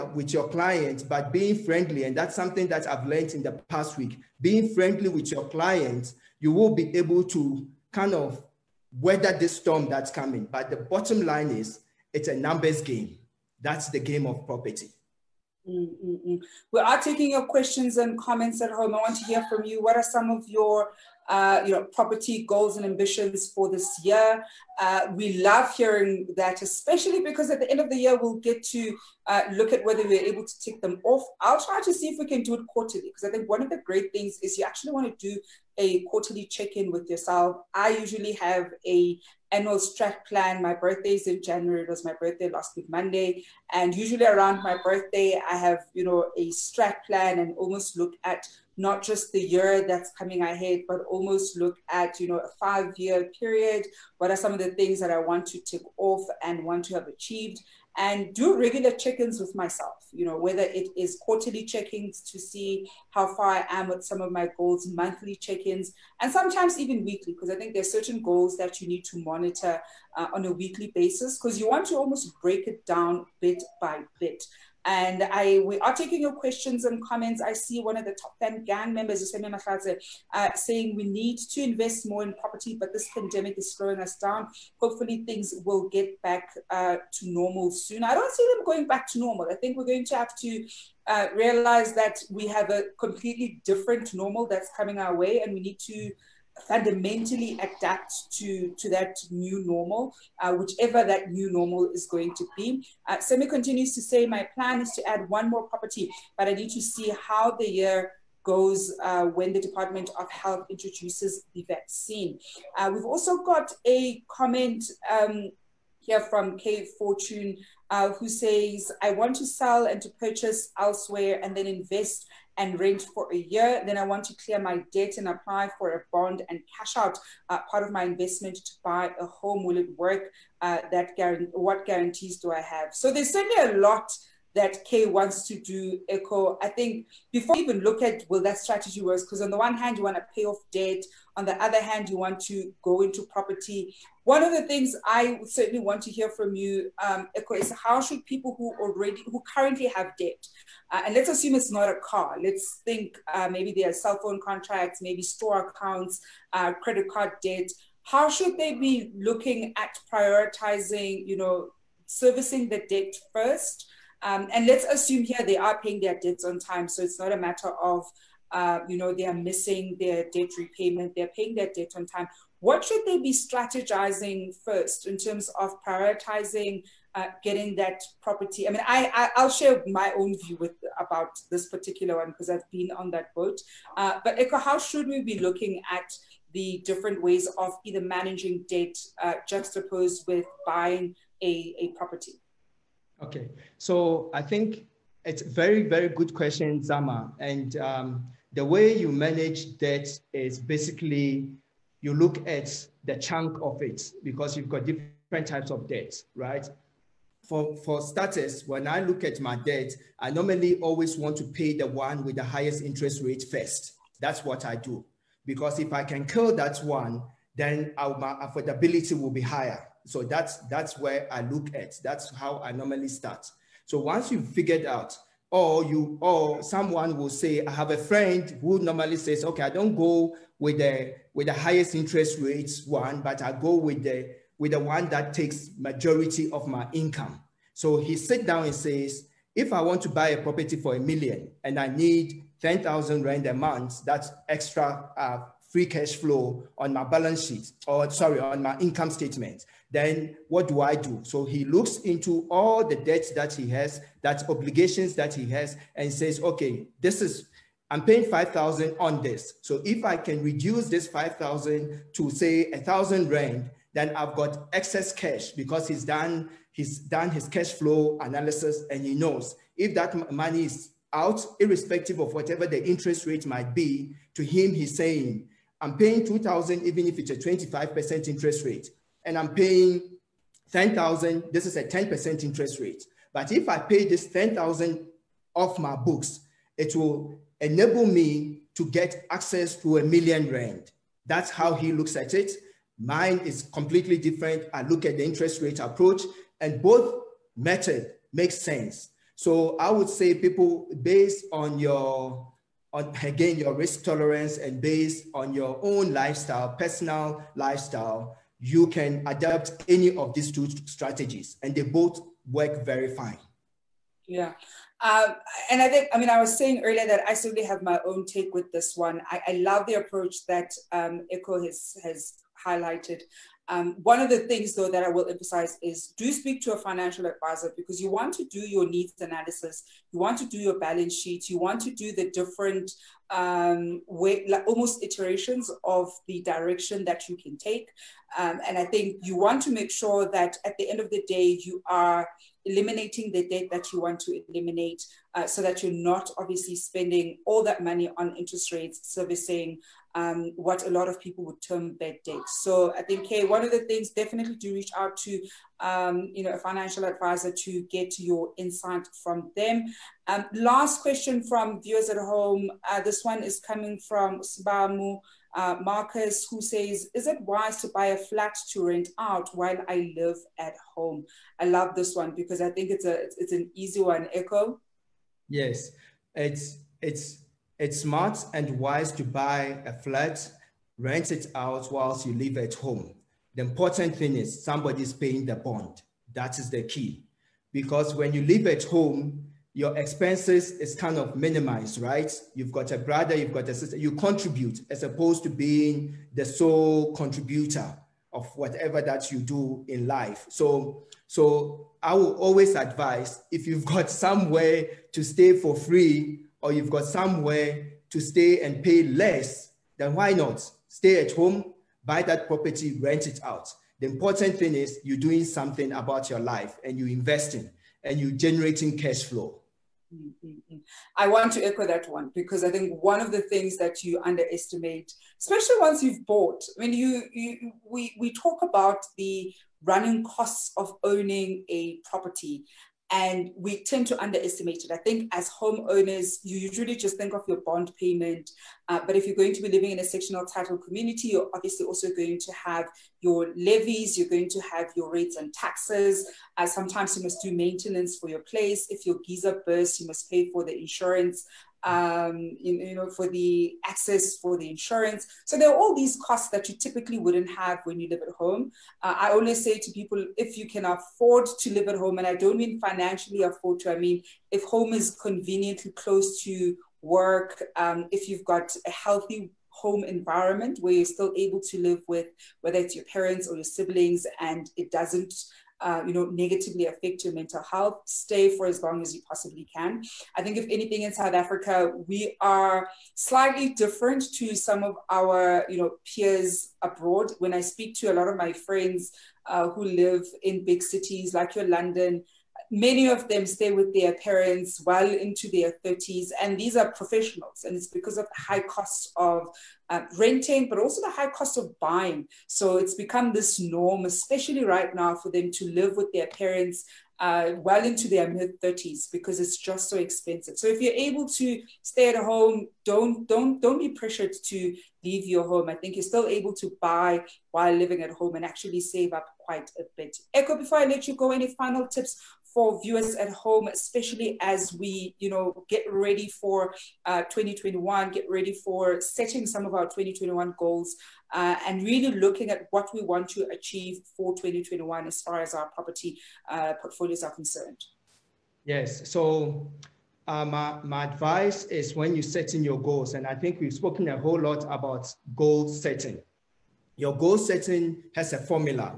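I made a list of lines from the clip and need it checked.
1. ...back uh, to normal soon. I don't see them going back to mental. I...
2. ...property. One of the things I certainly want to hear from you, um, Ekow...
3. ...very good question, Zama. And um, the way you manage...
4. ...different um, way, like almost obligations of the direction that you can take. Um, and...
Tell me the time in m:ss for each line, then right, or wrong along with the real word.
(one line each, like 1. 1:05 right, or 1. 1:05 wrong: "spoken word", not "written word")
1. 1:26 wrong: "normal", not "mental"
2. 2:23 right
3. 3:15 right
4. 5:32 wrong: "iterations", not "obligations".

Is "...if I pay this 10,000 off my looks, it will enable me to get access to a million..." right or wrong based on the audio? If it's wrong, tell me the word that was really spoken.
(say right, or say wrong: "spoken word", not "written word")
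wrong: "books", not "looks".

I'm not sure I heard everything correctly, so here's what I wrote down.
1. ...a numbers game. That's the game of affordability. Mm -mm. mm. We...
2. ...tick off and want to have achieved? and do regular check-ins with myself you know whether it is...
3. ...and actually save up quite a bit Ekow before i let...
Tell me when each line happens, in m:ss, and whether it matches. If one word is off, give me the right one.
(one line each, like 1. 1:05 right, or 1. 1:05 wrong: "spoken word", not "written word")
1. 0:12 wrong: "property", not "affordability"
2. 0:55 right
3. 8:38 right.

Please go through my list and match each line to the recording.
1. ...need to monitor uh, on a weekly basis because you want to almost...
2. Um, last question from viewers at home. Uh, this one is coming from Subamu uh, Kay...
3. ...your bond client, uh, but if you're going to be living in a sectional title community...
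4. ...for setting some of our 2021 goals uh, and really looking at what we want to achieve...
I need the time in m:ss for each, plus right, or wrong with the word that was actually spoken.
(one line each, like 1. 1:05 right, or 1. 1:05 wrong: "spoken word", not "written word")
1. 1:08 right
2. 6:00 wrong: "Marcus", not "Kay"
3. 7:17 wrong: "payment", not "client"
4. 8:48 right.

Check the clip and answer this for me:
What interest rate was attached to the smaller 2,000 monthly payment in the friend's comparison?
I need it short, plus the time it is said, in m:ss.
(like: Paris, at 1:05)
25%, at 4:37.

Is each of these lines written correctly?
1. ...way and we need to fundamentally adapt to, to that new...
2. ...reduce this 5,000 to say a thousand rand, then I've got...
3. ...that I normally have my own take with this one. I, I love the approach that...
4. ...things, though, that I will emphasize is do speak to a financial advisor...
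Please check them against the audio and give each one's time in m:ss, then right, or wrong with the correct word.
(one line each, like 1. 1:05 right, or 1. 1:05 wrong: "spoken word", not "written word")
1. 1:35 right
2. 4:20 right
3. 5:17 wrong: "certainly", not "normally"
4. 5:24 right.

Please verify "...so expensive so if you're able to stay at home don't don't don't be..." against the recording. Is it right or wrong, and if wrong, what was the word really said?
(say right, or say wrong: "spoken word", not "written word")
right.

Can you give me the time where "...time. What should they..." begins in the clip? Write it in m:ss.
2:52.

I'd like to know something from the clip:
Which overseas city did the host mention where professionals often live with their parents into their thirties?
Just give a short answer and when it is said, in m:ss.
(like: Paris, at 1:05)
London, at 8:11.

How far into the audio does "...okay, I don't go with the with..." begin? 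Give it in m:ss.
3:49.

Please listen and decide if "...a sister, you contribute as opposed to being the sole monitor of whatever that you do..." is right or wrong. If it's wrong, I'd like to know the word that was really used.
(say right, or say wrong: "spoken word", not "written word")
wrong: "contributor", not "monitor".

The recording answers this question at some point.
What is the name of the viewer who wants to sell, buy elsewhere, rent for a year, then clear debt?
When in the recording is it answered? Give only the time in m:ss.
1:56.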